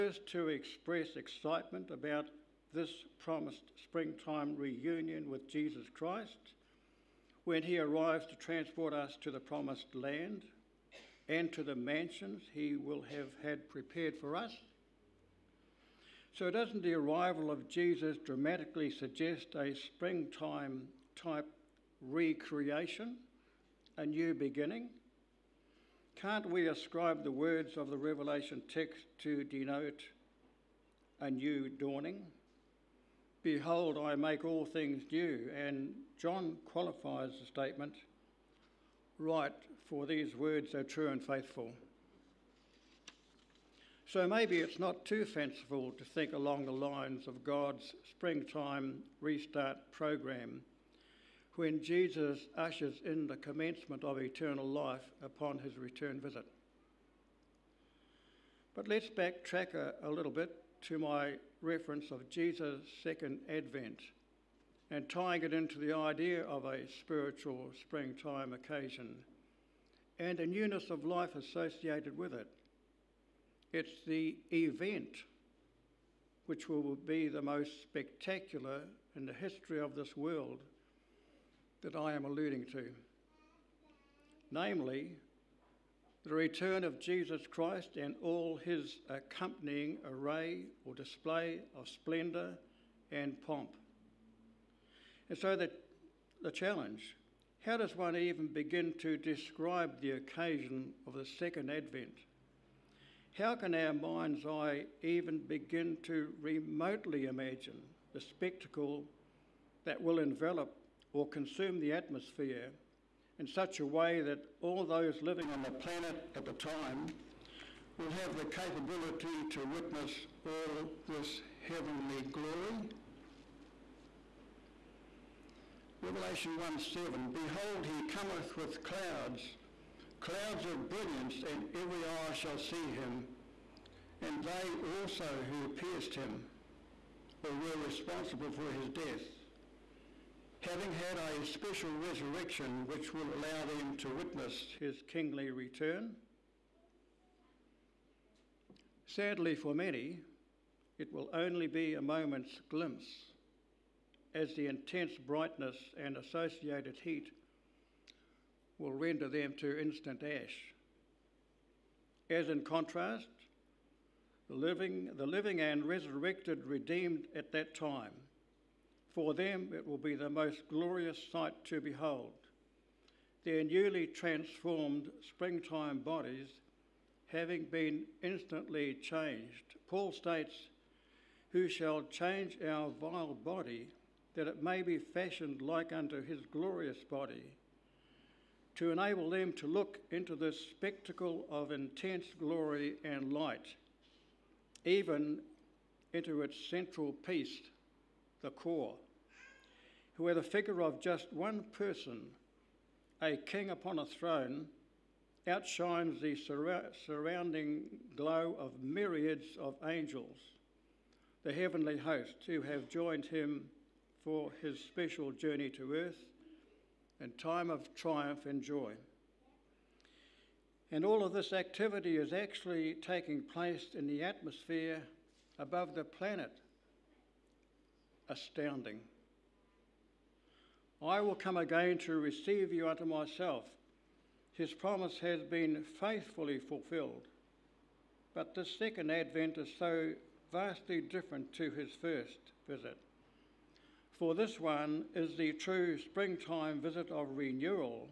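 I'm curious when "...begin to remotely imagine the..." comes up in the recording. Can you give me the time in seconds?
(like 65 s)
105 s.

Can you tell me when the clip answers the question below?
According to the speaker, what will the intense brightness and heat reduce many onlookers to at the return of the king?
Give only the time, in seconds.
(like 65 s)
159 s.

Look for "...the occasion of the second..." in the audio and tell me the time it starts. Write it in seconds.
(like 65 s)
99 s.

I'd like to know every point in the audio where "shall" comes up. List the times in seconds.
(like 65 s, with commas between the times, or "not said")
132 s, 181 s.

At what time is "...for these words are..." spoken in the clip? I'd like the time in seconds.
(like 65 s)
39 s.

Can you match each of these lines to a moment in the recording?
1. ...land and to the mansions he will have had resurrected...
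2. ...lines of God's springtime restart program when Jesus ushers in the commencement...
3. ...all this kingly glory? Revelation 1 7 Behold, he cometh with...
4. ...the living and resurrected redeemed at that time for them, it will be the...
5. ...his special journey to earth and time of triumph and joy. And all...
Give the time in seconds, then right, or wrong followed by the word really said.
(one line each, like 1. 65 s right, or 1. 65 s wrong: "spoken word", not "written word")
1. 9 s wrong: "prepared", not "resurrected"
2. 46 s right
3. 120 s wrong: "heavenly", not "kingly"
4. 165 s right
5. 214 s right.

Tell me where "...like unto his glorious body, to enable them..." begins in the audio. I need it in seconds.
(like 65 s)
185 s.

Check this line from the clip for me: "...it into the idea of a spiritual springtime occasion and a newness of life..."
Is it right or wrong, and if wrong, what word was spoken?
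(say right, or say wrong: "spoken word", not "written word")
right.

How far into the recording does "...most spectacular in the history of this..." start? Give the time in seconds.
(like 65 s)
77 s.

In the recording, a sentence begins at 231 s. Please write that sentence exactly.
I will come again to receive you unto myself.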